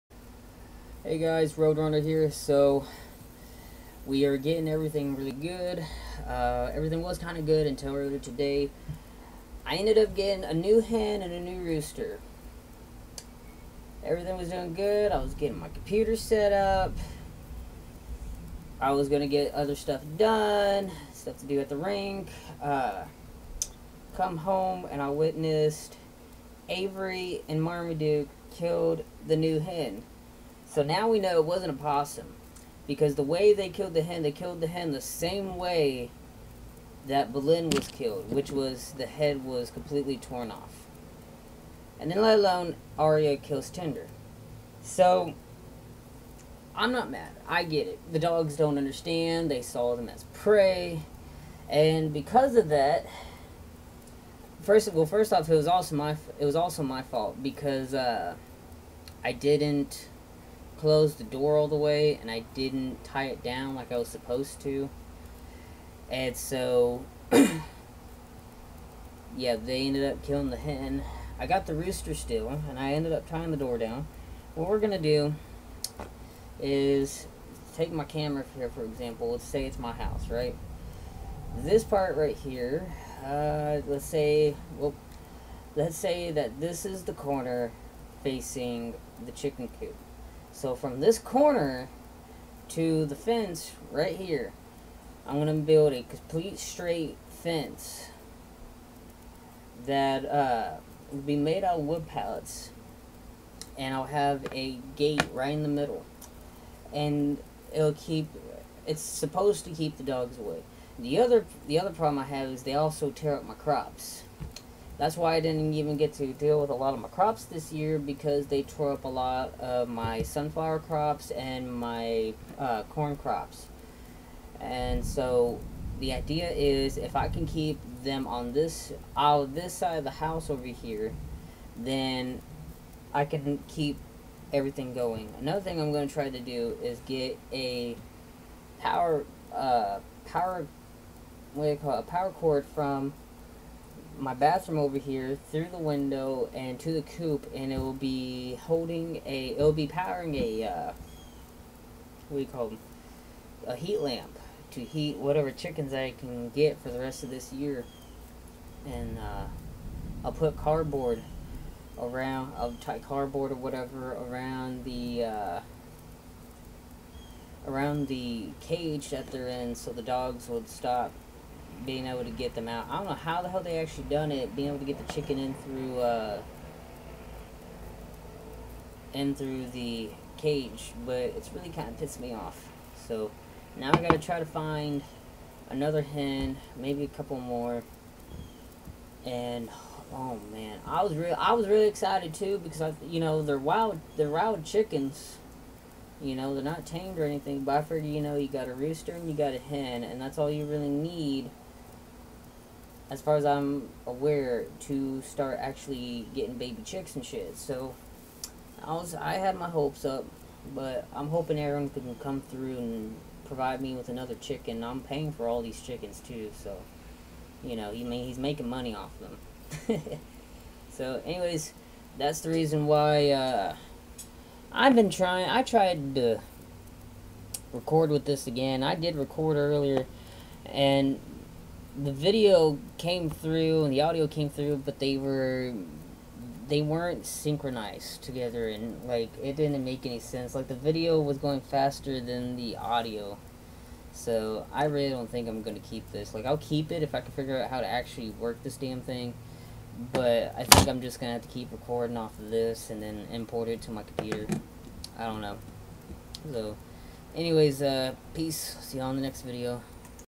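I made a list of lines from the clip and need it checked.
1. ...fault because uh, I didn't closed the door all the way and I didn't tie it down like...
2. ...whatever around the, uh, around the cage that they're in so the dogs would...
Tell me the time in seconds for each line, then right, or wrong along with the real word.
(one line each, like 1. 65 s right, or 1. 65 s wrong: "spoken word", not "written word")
1. 57 s right
2. 163 s right.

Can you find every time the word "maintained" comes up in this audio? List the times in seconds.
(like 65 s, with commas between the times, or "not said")
not said.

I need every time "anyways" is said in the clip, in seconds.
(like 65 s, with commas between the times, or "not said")
221 s, 257 s.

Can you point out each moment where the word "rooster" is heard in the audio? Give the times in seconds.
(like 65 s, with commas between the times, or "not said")
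11 s, 71 s, 198 s.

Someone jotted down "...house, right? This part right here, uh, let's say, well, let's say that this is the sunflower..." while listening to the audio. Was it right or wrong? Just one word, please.
wrong.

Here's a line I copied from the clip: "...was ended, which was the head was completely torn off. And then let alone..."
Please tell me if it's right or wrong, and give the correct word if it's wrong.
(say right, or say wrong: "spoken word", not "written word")
wrong: "killed", not "ended".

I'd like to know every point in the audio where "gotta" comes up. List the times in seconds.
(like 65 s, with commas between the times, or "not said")
184 s.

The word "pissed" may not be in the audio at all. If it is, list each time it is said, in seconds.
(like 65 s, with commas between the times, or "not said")
181 s.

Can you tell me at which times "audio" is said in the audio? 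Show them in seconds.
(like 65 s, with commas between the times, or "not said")
234 s, 242 s.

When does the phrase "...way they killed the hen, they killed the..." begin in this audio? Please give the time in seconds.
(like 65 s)
33 s.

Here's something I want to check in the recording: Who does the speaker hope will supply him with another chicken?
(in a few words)
Aaron.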